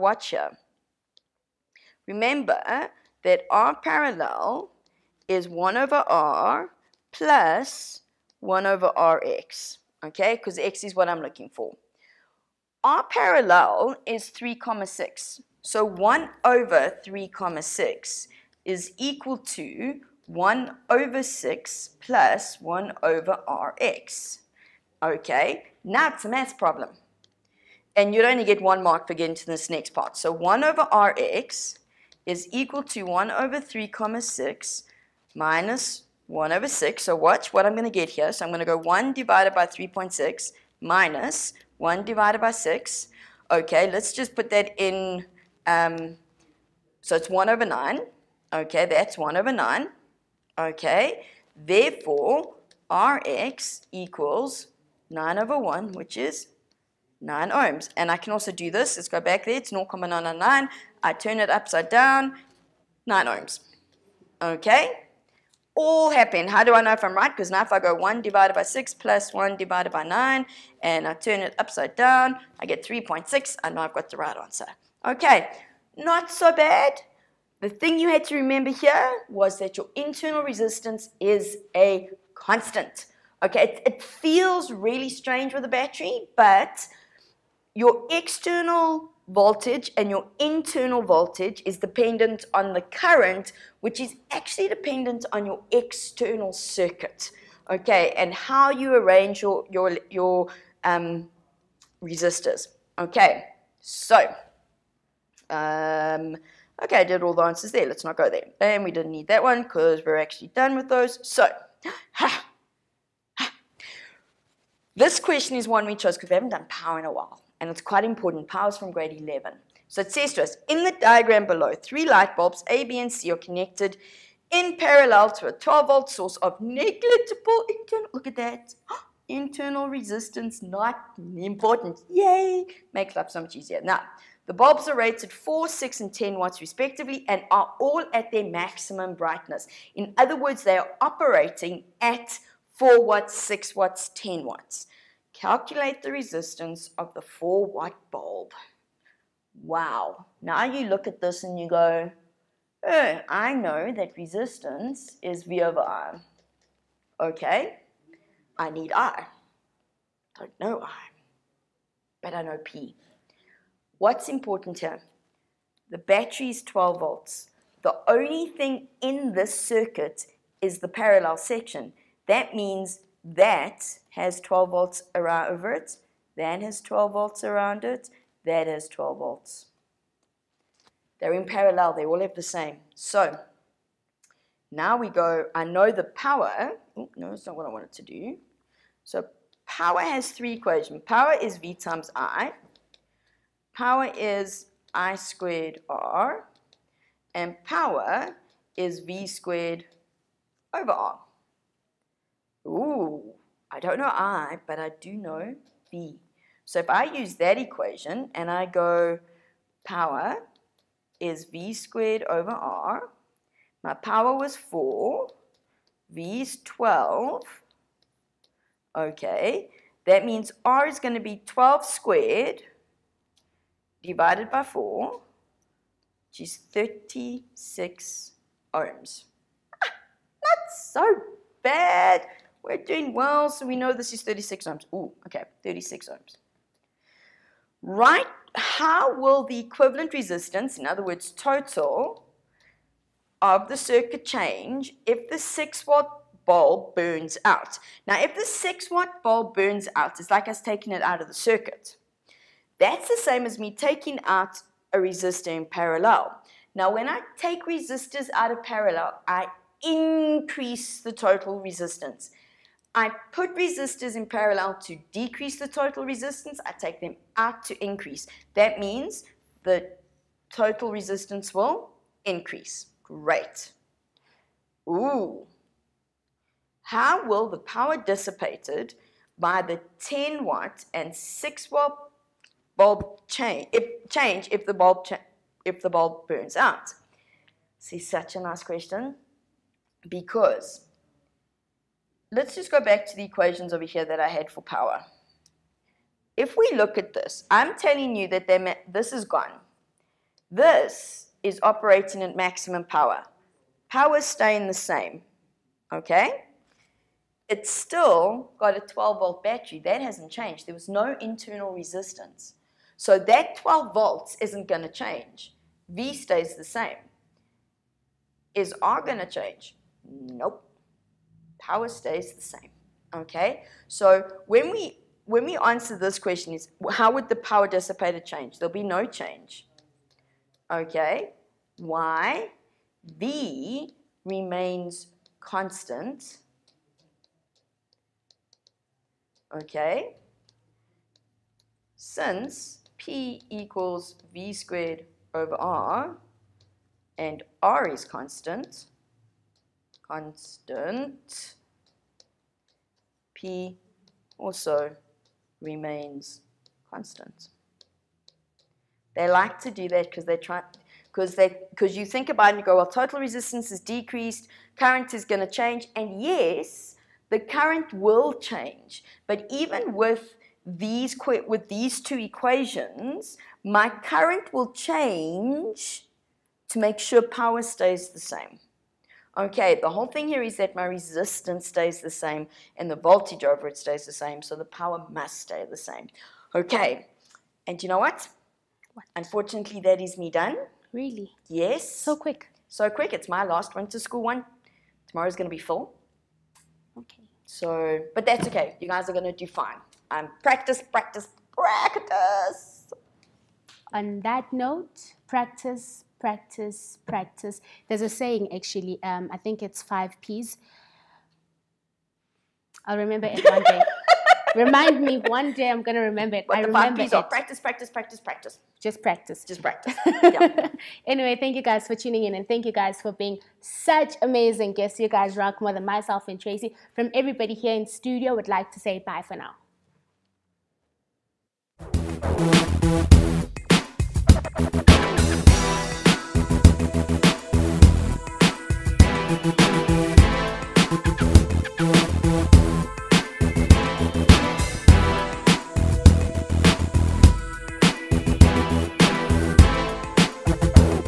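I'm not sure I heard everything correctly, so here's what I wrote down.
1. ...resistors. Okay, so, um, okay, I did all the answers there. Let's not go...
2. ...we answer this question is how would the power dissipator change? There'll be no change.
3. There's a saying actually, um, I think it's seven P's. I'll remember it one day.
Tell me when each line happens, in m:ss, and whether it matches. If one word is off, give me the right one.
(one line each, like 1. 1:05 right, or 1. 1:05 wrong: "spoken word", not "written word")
1. 1:42 right
2. 5:25 right
3. 6:47 wrong: "five", not "seven".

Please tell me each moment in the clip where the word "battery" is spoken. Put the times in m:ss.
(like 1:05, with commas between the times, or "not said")
1:25, 2:45, 5:09.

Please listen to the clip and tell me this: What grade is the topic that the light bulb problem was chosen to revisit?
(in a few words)
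Grade 11.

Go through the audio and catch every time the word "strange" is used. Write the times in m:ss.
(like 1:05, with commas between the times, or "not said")
1:25.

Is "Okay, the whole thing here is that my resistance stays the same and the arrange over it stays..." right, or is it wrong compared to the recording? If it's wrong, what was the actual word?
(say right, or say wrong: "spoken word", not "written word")
wrong: "voltage", not "arrange".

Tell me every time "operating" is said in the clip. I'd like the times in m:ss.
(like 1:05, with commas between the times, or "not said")
2:21, 5:01.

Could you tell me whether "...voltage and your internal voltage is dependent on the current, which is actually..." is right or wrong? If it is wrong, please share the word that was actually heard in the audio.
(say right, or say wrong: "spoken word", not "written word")
right.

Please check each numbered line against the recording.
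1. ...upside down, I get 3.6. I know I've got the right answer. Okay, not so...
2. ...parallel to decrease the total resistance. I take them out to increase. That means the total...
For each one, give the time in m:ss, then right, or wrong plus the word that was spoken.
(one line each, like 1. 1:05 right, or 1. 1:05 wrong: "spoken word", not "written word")
1. 1:11 right
2. 4:24 right.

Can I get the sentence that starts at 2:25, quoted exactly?
Calculate the resistance of the four white bulb.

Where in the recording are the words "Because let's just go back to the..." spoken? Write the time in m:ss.
4:50.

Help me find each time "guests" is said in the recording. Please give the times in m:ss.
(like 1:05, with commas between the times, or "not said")
7:04.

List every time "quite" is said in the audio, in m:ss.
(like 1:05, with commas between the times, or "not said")
1:57.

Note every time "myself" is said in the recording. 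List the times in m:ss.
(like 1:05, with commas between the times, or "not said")
7:05.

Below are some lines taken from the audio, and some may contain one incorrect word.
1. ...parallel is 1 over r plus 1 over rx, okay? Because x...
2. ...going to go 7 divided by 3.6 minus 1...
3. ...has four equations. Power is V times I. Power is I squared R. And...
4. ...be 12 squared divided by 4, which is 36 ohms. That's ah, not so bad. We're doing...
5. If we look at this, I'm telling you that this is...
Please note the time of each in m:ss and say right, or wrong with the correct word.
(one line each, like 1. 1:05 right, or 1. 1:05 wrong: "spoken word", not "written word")
1. 0:03 right
2. 0:38 wrong: "1", not "7"
3. 3:09 wrong: "three", not "four"
4. 3:41 right
5. 4:56 right.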